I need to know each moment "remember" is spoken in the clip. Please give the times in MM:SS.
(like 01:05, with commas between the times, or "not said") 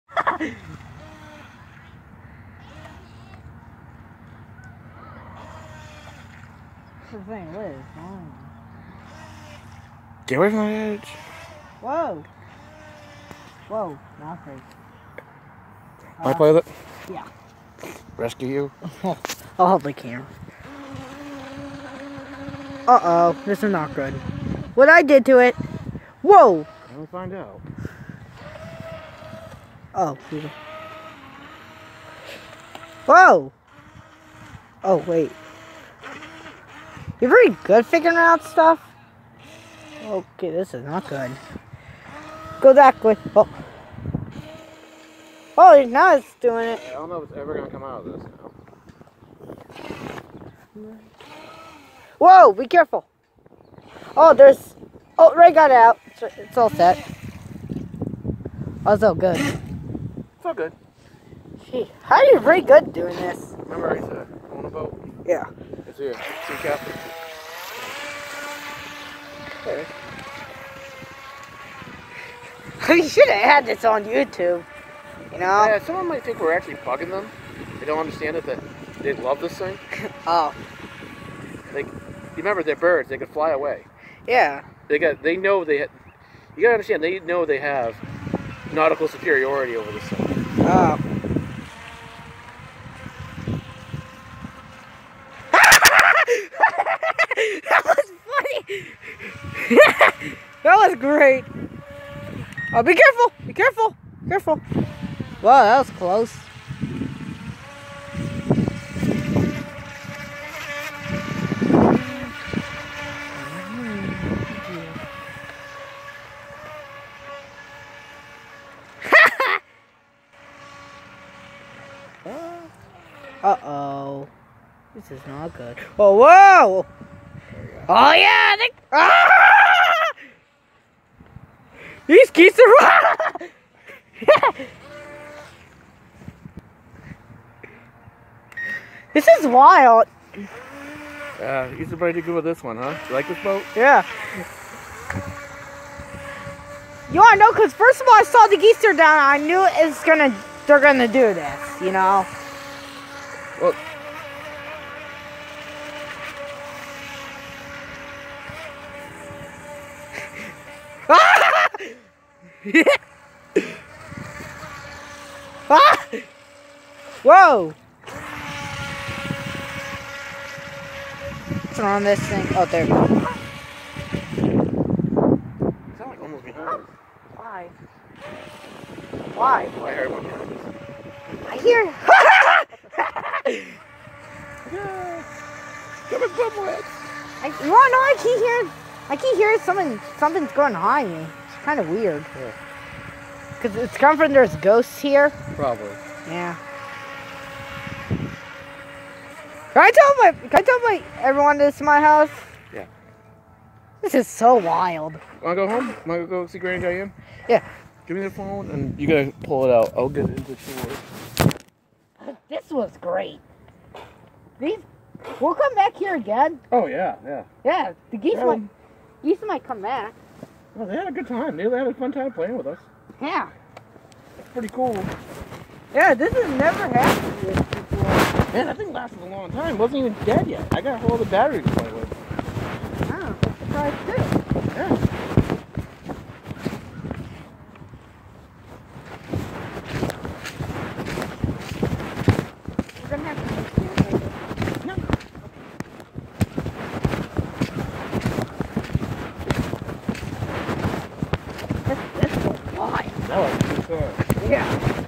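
01:03, 01:22.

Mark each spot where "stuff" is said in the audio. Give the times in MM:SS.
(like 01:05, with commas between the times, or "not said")
00:38, 01:35.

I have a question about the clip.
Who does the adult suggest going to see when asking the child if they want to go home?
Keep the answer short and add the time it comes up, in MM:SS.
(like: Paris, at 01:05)
Granny Diane, at 03:26.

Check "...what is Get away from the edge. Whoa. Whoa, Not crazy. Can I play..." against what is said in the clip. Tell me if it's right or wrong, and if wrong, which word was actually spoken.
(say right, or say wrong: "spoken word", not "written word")
right.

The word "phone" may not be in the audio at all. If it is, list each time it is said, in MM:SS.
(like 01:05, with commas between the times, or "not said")
03:28.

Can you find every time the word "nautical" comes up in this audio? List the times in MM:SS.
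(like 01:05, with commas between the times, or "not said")
01:28.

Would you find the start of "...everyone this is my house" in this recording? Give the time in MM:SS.
03:21.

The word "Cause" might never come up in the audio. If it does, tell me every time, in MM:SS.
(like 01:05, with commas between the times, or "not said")
02:27, 03:13.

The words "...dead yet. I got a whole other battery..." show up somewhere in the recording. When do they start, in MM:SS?
03:50.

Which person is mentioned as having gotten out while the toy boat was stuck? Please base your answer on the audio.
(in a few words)
Ray.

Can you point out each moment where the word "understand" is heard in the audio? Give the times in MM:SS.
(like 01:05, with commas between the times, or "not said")
01:17, 01:26.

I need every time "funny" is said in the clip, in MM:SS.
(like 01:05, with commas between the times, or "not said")
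01:38.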